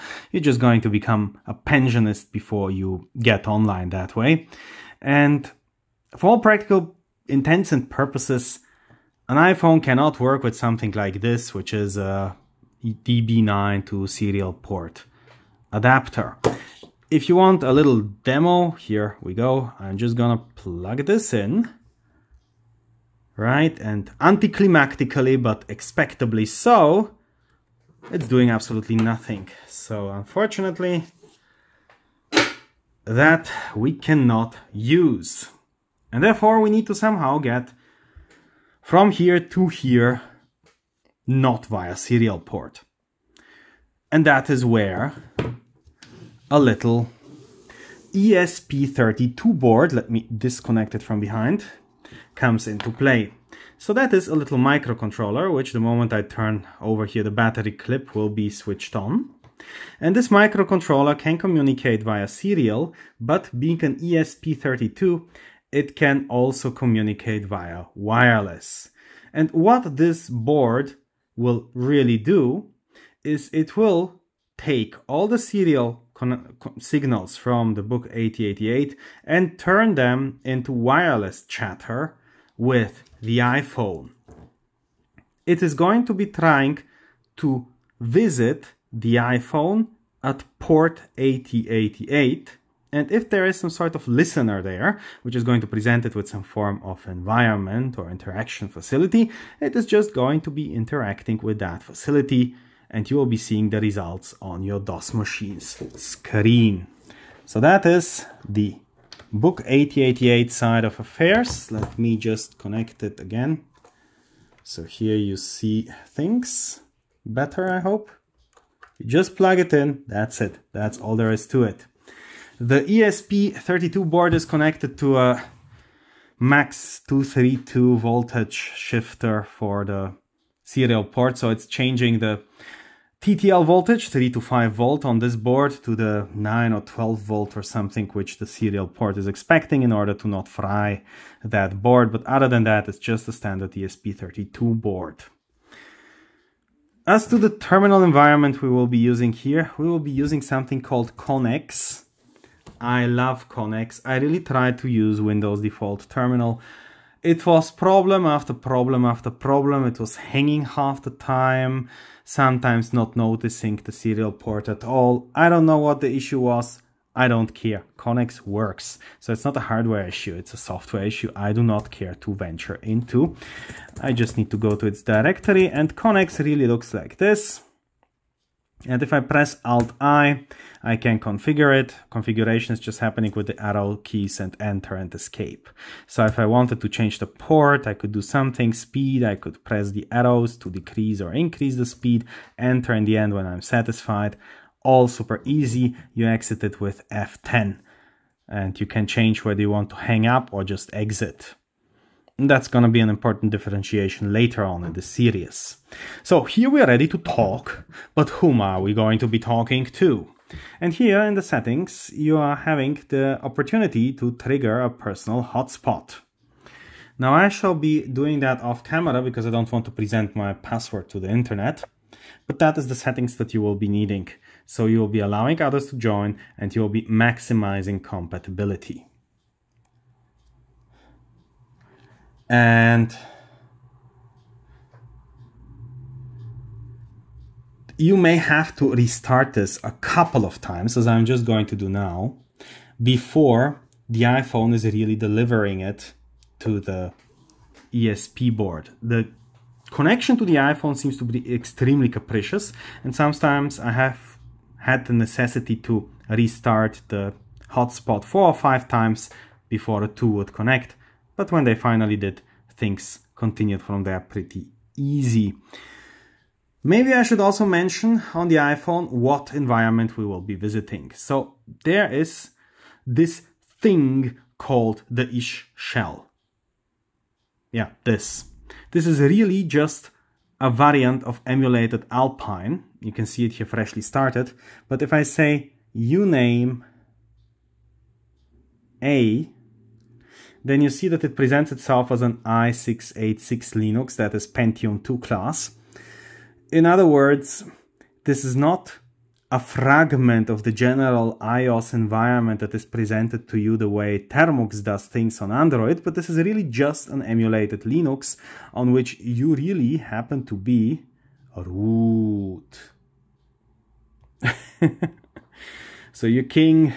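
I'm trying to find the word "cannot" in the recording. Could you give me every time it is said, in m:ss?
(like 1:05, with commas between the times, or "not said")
0:09, 0:33.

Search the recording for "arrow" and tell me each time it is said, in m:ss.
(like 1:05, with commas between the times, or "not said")
3:03, 3:10.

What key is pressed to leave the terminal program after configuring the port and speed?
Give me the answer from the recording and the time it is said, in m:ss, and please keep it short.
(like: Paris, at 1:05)
F10, at 3:17.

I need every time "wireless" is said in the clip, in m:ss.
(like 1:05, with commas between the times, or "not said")
1:07, 1:20.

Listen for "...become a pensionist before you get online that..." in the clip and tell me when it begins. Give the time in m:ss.
0:00.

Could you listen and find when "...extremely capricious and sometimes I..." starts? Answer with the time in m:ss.
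4:11.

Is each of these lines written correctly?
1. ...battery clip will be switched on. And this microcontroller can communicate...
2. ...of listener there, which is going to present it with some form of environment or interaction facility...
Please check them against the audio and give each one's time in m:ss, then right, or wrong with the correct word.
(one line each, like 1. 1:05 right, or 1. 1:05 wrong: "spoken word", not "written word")
1. 0:57 right
2. 1:33 right.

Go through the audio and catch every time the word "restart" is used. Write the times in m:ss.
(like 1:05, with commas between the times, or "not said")
3:58, 4:16.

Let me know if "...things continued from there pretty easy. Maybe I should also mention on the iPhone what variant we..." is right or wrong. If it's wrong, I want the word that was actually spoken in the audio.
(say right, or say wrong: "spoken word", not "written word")
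wrong: "environment", not "variant".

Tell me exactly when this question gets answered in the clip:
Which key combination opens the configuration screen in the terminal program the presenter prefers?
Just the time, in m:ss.
2:59.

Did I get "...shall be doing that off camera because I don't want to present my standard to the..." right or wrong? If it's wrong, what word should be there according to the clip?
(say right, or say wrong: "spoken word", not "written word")
wrong: "password", not "standard".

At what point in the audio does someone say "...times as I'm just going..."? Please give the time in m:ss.
4:00.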